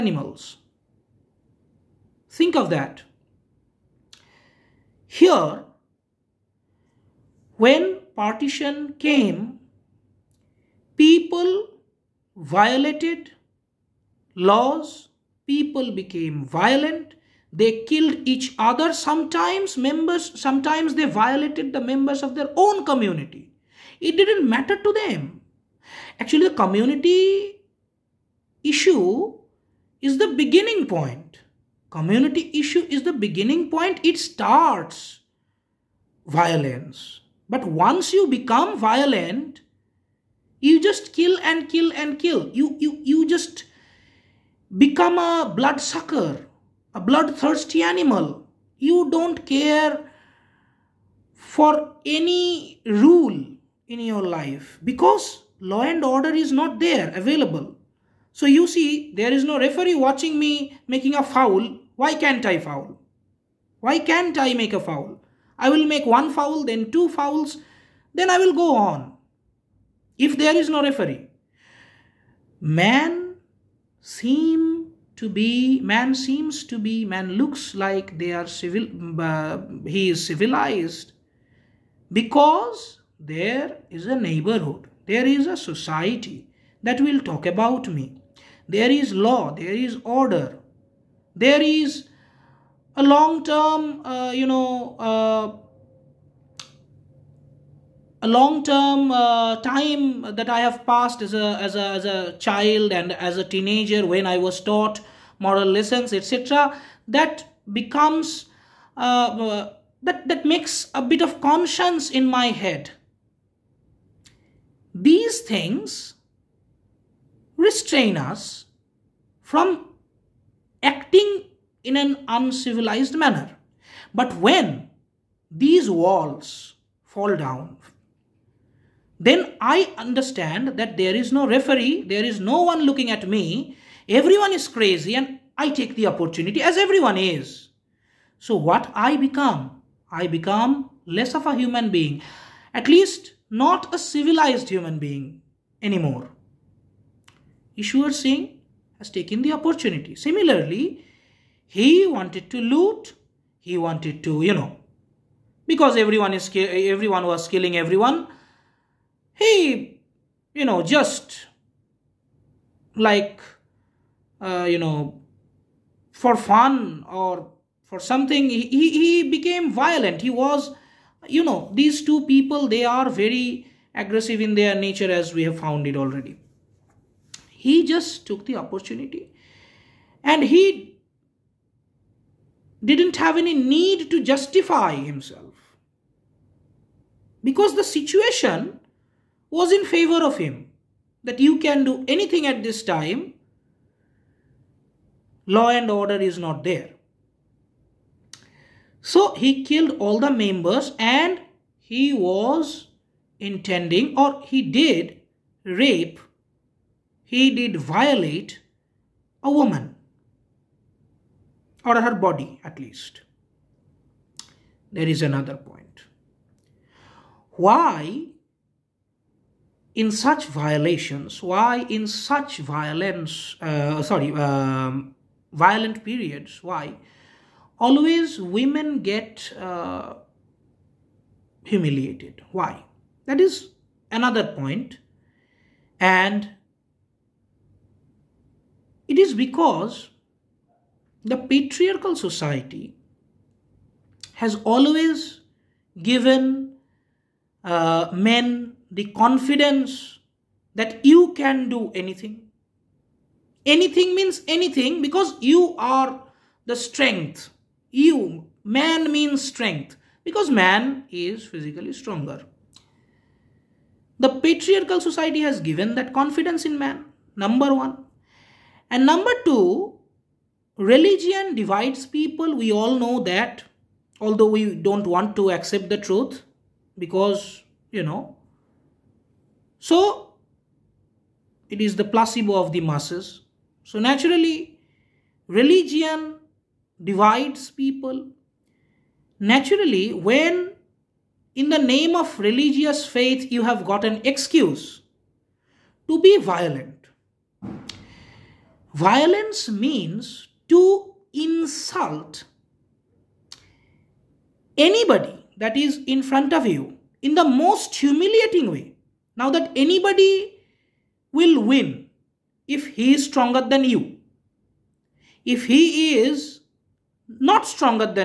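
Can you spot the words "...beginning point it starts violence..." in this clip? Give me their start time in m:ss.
0:33.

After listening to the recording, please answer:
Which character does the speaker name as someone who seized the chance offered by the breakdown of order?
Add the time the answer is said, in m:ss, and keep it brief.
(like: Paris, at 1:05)
Ishwar Singh, at 2:27.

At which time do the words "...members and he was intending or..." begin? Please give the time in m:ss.
3:20.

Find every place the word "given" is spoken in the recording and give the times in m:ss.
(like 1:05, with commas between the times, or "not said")
4:06, 4:25.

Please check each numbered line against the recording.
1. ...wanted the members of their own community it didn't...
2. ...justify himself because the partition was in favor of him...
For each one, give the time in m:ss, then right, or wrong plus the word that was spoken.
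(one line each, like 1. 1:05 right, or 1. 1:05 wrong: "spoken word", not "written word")
1. 0:21 wrong: "violated", not "wanted"
2. 3:04 wrong: "situation", not "partition".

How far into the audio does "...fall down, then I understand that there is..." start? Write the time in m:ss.
2:07.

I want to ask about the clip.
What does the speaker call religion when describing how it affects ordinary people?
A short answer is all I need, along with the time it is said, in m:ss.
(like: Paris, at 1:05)
The placebo of the masses, at 4:42.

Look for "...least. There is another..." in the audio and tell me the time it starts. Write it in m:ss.
3:32.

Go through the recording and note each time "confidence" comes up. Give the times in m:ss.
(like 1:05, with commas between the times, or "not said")
4:09, 4:26.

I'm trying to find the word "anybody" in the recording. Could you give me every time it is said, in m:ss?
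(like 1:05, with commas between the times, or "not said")
5:04, 5:09.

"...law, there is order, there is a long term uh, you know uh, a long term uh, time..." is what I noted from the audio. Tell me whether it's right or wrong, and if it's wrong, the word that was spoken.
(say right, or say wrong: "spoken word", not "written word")
right.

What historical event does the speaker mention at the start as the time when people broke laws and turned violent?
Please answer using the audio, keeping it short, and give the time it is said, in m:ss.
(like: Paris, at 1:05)
Partition, at 0:08.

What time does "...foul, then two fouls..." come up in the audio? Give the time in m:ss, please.
1:06.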